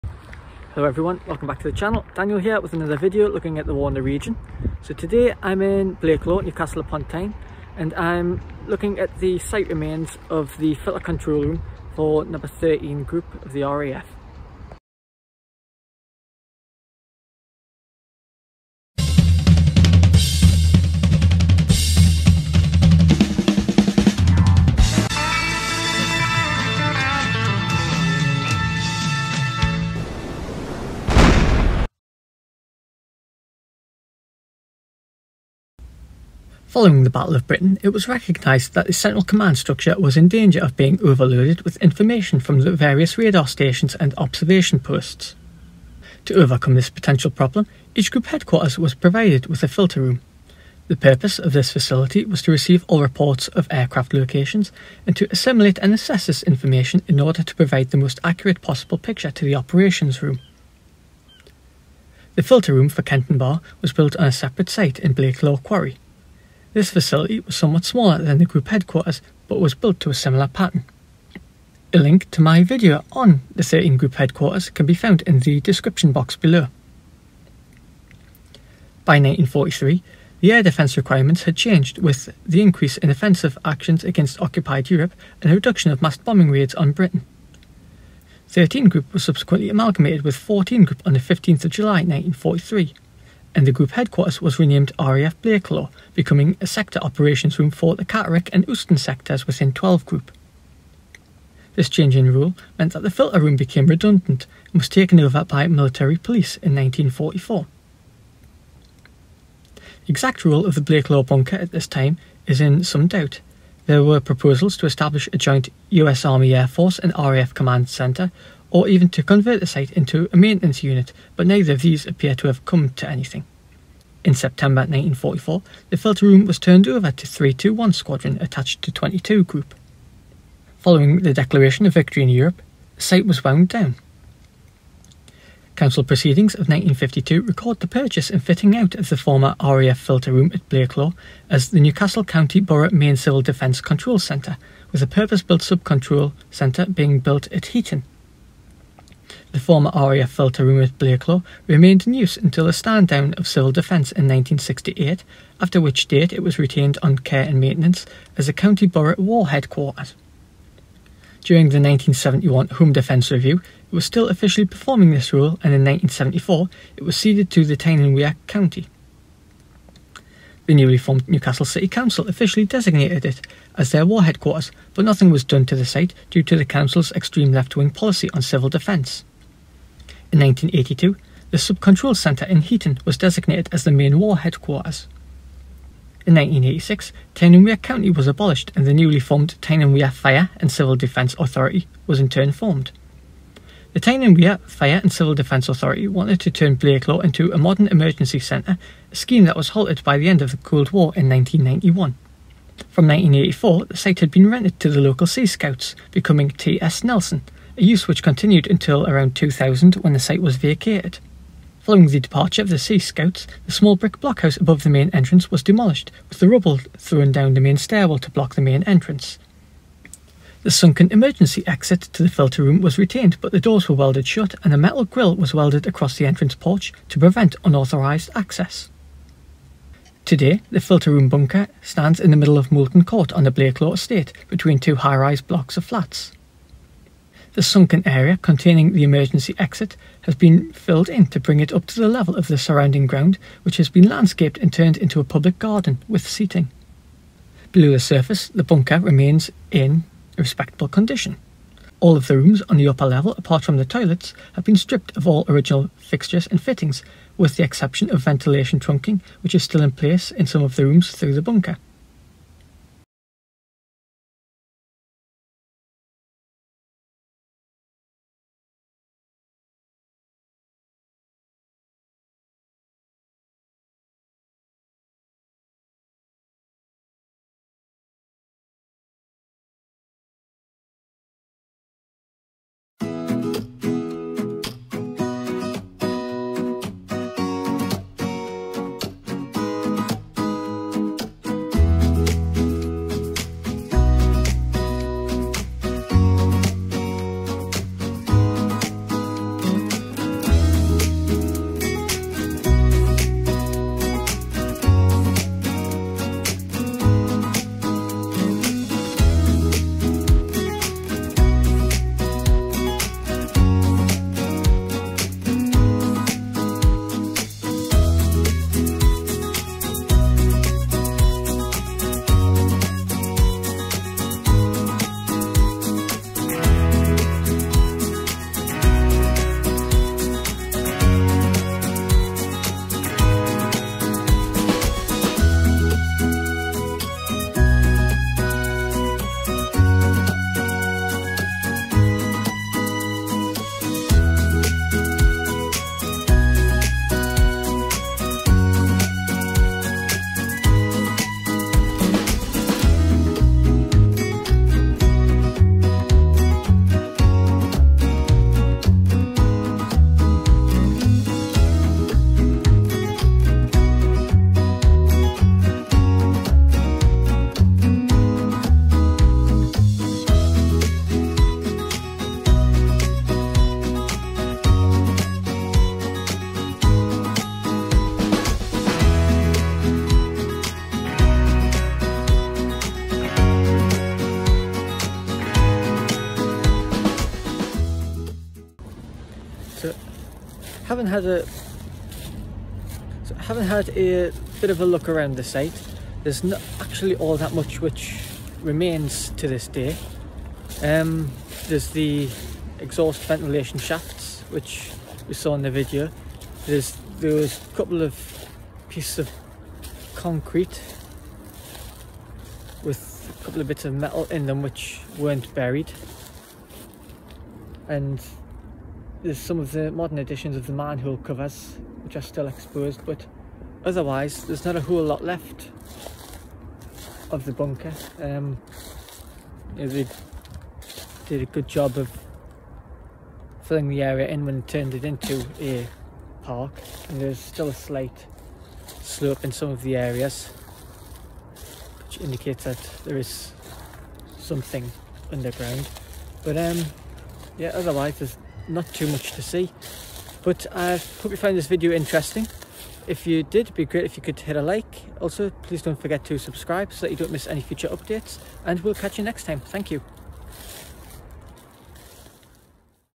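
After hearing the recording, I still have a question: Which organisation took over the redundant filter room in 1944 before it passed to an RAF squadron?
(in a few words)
Military police.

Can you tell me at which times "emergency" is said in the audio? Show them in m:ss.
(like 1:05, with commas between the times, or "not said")
3:17, 3:41, 3:59.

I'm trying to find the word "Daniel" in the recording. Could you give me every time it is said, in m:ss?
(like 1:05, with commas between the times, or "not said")
0:02.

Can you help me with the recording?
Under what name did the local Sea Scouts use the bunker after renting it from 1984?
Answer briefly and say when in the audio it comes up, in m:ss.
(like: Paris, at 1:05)
T.S. Nelson, at 3:26.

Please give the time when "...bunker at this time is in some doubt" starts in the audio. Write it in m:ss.
1:51.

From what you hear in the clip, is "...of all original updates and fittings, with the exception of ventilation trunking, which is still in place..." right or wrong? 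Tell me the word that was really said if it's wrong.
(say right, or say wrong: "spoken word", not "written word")
wrong: "fixtures", not "updates".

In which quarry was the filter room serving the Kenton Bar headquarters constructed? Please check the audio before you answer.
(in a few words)
Law Quarry.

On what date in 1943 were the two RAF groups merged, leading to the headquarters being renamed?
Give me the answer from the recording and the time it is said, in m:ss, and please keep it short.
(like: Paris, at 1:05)
15 July 1943, at 1:31.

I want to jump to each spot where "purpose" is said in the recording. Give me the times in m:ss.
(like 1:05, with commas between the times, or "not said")
0:50, 2:25.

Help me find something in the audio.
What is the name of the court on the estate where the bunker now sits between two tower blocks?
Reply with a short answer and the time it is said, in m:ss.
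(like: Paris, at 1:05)
Moulton Court, at 3:52.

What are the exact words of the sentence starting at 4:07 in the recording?
Below the surface, the bunker remains in respectable condition.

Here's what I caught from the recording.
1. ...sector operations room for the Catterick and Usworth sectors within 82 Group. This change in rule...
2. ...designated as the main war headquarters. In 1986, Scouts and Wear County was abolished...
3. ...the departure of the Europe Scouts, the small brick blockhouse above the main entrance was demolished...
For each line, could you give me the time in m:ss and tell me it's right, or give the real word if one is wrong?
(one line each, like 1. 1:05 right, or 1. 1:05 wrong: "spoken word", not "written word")
1. 1:36 wrong: "12", not "82"
2. 3:03 wrong: "Tyne", not "Scouts"
3. 3:32 wrong: "Sea", not "Europe".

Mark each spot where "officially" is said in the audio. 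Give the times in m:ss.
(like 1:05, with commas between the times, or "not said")
2:44, 2:52.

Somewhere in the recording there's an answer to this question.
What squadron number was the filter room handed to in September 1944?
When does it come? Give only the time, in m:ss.
2:07.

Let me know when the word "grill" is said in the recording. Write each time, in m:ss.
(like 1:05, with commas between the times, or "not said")
3:45.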